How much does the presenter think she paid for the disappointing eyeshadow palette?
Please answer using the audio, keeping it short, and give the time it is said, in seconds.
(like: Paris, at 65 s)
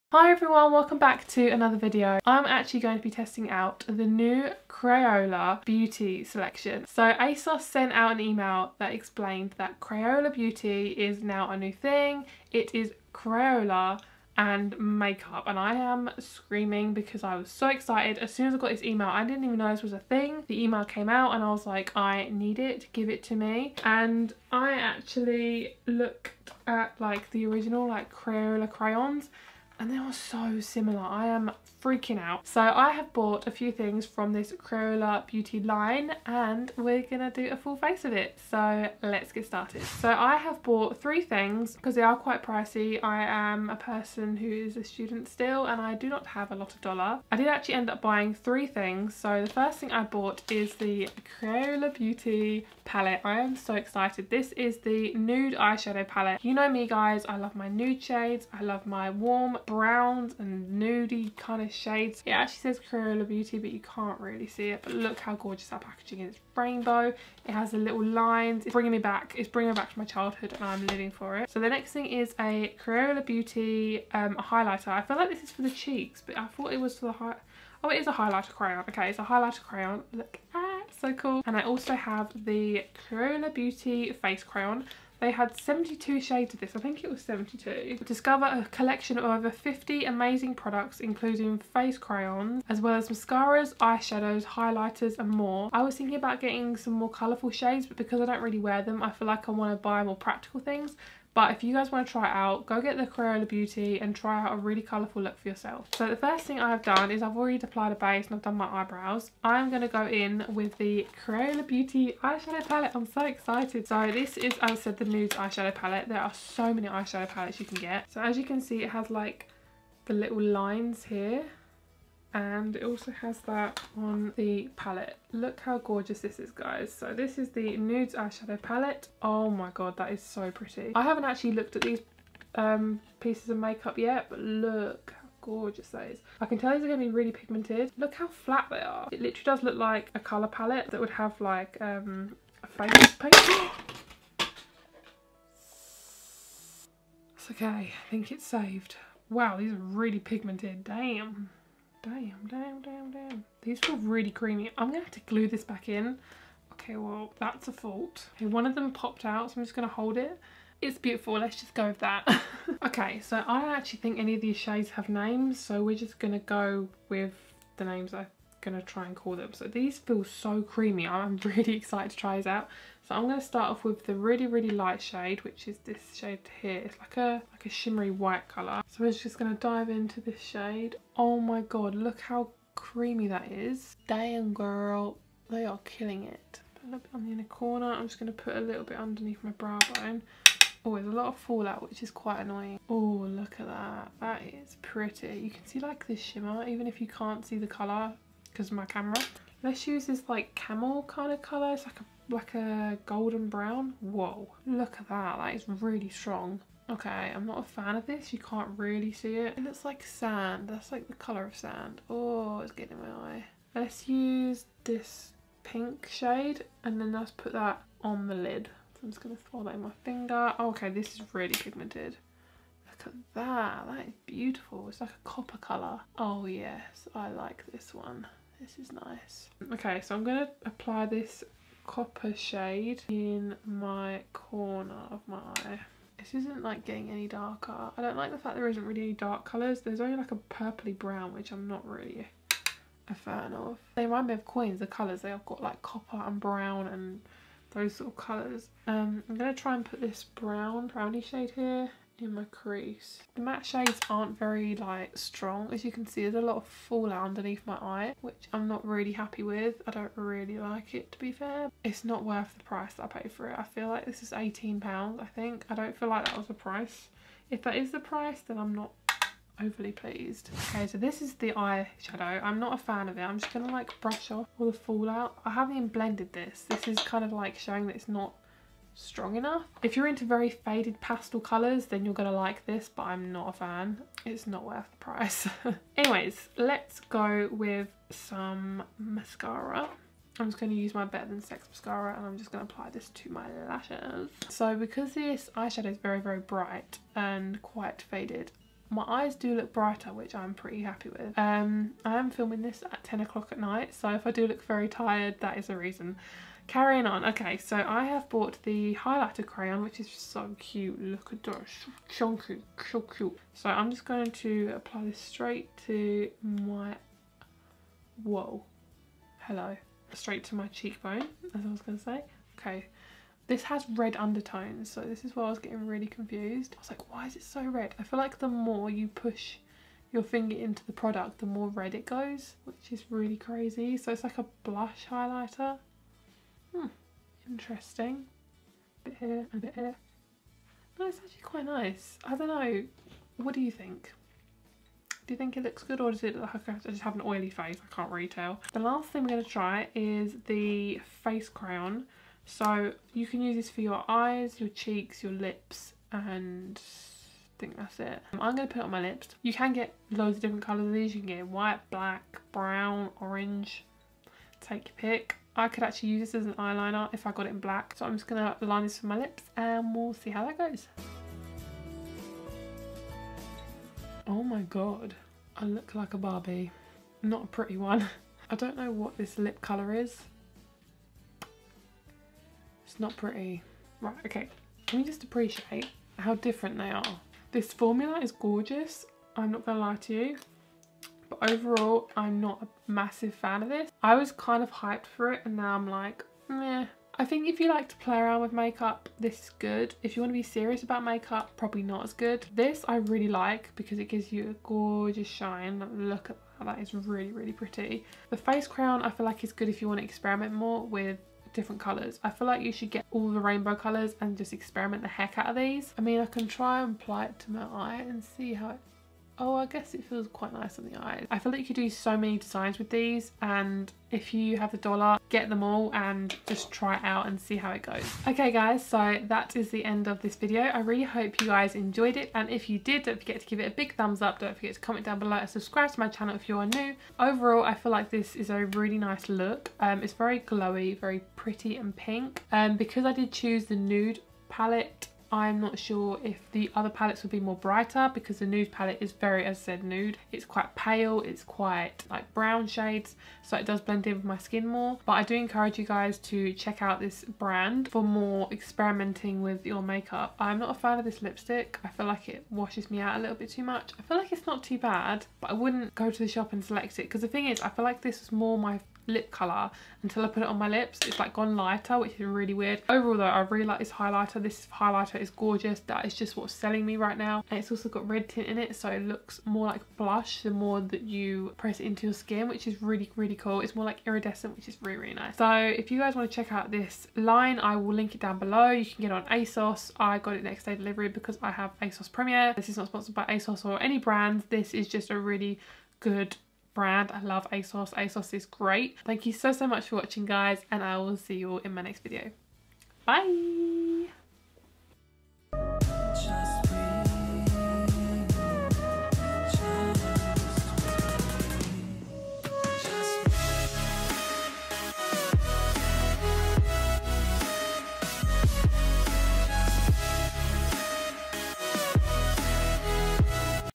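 £18, at 264 s.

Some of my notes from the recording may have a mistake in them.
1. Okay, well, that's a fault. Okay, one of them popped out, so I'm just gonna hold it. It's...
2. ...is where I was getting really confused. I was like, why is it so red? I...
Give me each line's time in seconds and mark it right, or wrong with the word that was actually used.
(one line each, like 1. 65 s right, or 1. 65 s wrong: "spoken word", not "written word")
1. 156 s right
2. 325 s right.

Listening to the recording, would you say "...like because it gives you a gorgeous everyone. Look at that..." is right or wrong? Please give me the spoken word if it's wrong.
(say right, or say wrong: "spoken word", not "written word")
wrong: "shine", not "everyone".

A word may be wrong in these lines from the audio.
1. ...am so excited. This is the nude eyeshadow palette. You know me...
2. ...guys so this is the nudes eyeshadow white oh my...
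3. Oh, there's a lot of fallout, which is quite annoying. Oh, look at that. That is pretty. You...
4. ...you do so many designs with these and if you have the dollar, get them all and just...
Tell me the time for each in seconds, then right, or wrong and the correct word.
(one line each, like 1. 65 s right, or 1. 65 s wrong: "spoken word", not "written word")
1. 53 s right
2. 126 s wrong: "palette", not "white"
3. 190 s right
4. 421 s right.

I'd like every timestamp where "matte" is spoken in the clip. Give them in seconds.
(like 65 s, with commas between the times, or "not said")
253 s.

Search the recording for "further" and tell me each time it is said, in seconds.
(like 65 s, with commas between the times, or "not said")
not said.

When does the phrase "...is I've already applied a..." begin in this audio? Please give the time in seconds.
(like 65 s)
107 s.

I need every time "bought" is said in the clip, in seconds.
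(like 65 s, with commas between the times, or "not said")
33 s, 40 s, 50 s, 308 s.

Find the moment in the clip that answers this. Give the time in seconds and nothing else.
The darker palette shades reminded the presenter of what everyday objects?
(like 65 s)
244 s.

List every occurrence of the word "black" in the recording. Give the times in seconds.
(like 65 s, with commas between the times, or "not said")
361 s, 367 s.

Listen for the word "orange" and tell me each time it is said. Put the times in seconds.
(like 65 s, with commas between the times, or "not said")
363 s.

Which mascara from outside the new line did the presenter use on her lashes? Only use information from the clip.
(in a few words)
Better Than Sex.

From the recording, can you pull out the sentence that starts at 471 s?
It's like gone lighter, which is really weird.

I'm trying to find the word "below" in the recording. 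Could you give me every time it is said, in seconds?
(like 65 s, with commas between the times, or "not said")
435 s, 488 s.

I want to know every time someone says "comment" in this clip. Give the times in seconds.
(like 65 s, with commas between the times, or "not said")
434 s.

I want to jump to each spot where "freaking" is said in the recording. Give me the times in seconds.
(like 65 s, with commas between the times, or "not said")
31 s.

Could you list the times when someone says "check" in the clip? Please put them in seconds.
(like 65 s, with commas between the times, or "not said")
456 s, 486 s.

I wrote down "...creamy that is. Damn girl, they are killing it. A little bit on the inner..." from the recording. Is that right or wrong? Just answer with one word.
right.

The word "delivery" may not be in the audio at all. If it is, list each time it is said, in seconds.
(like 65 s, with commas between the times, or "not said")
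490 s.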